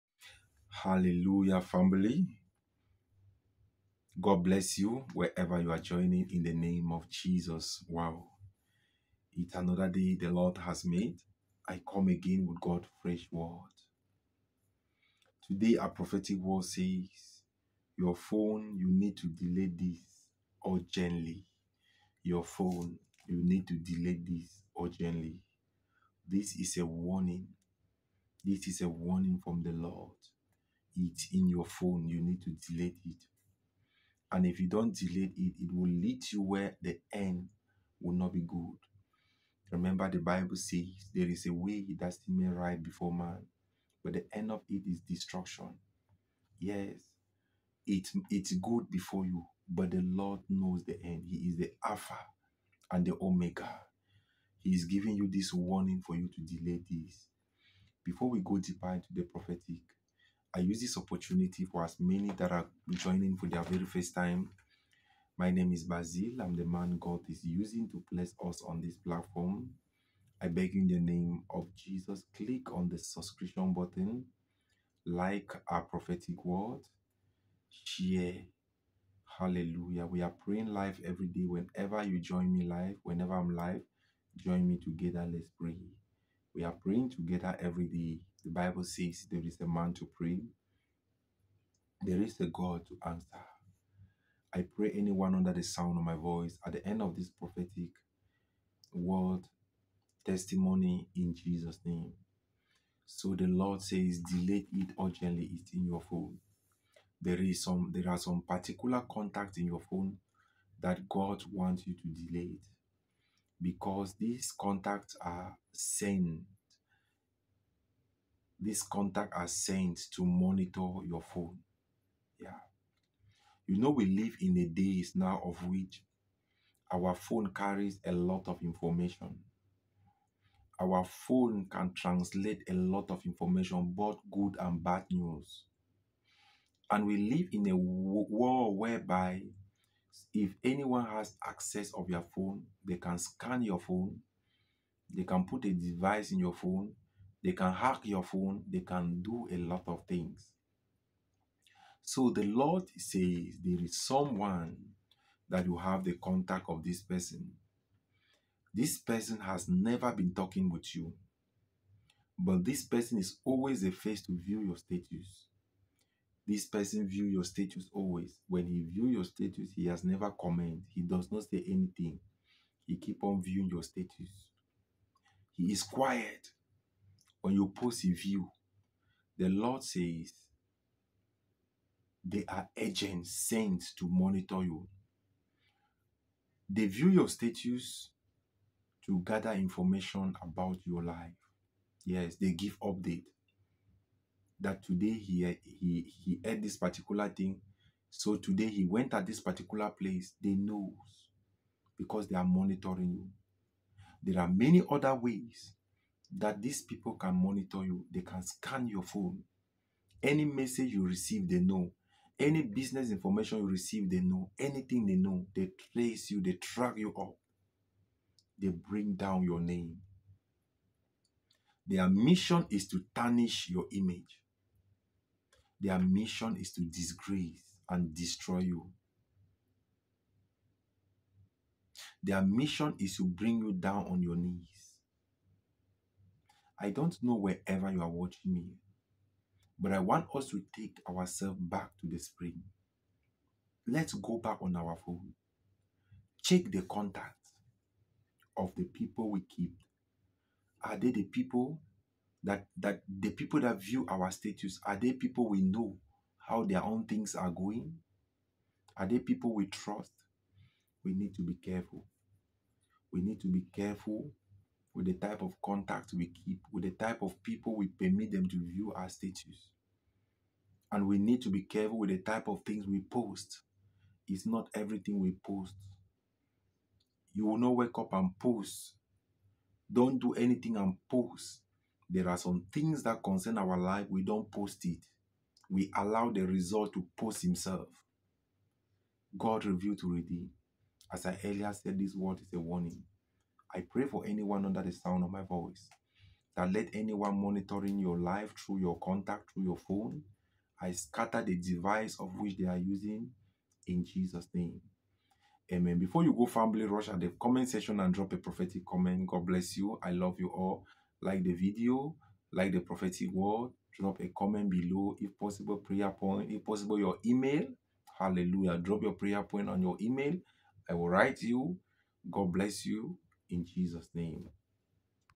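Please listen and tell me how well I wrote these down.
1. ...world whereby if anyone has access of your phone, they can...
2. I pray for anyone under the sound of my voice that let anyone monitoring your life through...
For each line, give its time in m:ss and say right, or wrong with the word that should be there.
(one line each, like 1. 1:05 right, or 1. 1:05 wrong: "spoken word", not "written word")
1. 2:17 right
2. 4:53 right.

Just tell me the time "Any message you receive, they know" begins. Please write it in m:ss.
3:30.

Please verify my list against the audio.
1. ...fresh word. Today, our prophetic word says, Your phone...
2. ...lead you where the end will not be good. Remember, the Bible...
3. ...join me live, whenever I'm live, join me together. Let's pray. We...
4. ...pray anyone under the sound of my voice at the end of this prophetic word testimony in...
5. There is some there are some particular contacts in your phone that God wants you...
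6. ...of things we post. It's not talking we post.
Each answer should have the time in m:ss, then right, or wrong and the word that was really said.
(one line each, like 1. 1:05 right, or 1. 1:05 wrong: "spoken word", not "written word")
1. 0:13 right
2. 0:35 right
3. 1:22 right
4. 1:34 right
5. 1:47 right
6. 4:32 wrong: "everything", not "talking".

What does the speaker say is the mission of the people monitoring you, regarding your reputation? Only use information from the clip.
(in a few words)
To tarnish your image.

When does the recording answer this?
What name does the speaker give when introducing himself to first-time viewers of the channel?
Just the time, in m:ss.
1:05.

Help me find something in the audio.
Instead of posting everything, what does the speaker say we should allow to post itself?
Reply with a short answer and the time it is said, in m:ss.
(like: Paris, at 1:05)
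The result, at 4:46.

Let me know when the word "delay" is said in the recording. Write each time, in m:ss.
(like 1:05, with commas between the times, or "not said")
0:19, 0:23, 0:56, 1:44, 1:52.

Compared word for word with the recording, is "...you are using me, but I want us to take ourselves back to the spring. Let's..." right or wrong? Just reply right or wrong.
wrong.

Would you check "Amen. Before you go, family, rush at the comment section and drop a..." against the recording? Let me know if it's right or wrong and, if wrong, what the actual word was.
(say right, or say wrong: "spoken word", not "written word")
right.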